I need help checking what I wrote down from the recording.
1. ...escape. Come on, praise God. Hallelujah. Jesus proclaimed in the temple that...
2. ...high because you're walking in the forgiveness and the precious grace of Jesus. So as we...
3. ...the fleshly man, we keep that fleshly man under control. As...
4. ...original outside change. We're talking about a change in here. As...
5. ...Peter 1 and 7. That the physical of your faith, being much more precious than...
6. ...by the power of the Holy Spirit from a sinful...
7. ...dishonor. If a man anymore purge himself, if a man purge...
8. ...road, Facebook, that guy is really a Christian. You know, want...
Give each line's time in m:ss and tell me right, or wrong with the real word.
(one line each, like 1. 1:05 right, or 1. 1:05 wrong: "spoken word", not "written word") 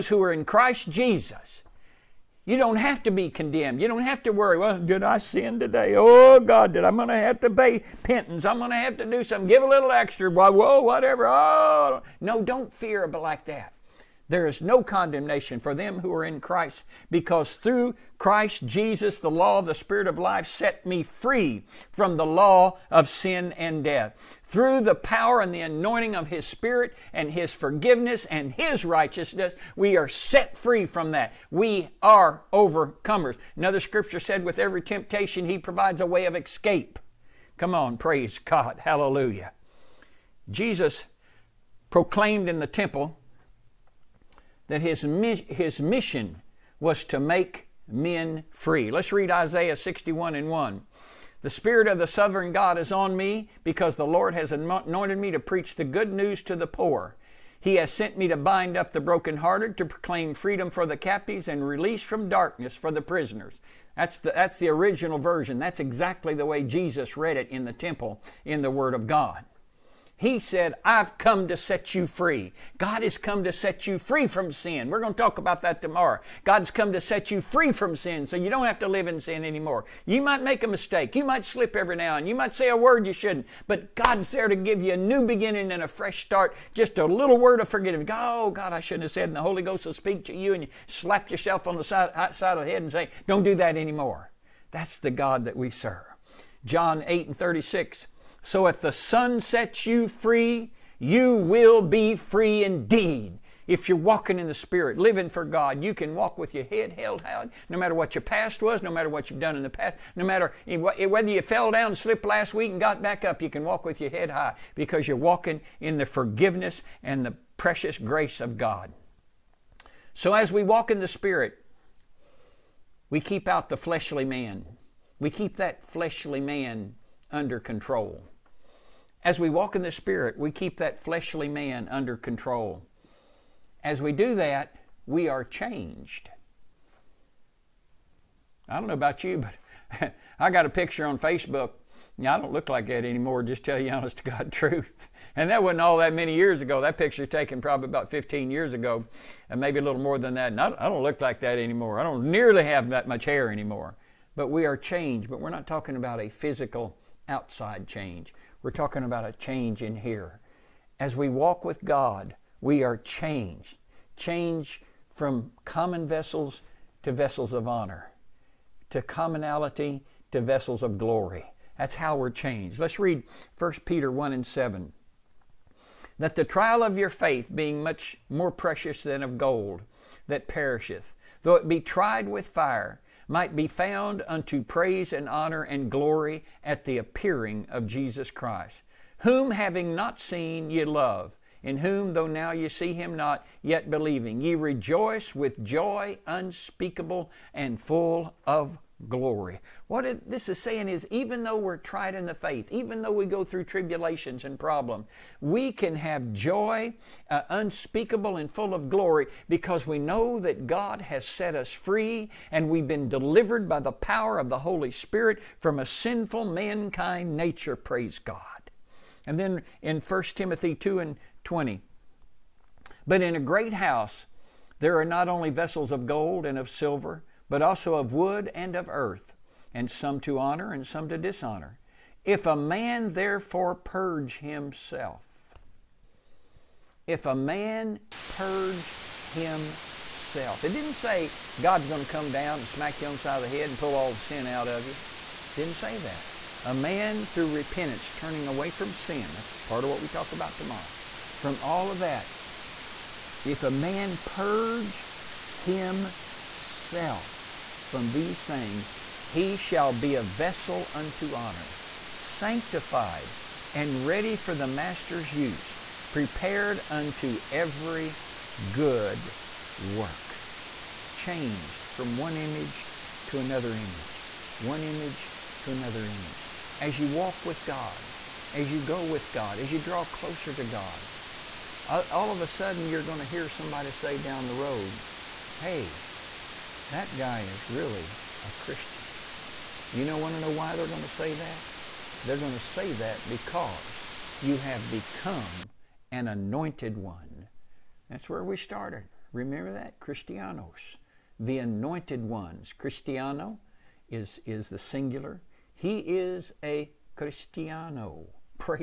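1. 0:36 right
2. 1:54 wrong: "God", not "Jesus"
3. 2:03 right
4. 2:36 wrong: "physical", not "original"
5. 2:53 wrong: "trial", not "physical"
6. 3:33 right
7. 3:51 wrong: "therefore", not "anymore"
8. 4:44 wrong: "Hey", not "Facebook".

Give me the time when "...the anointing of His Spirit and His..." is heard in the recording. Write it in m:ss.
0:25.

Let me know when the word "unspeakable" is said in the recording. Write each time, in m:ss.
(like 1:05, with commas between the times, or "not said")
3:16, 3:27.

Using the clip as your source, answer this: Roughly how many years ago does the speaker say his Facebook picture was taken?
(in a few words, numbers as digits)
15.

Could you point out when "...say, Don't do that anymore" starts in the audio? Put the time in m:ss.
1:32.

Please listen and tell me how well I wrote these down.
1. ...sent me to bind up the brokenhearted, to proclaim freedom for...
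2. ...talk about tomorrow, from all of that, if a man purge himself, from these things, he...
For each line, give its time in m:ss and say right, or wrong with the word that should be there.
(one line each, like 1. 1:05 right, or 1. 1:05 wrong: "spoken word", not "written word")
1. 0:57 right
2. 4:10 right.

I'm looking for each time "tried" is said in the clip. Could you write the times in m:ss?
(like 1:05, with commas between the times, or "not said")
3:01, 3:21.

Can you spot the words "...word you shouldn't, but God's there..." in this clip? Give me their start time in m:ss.
1:22.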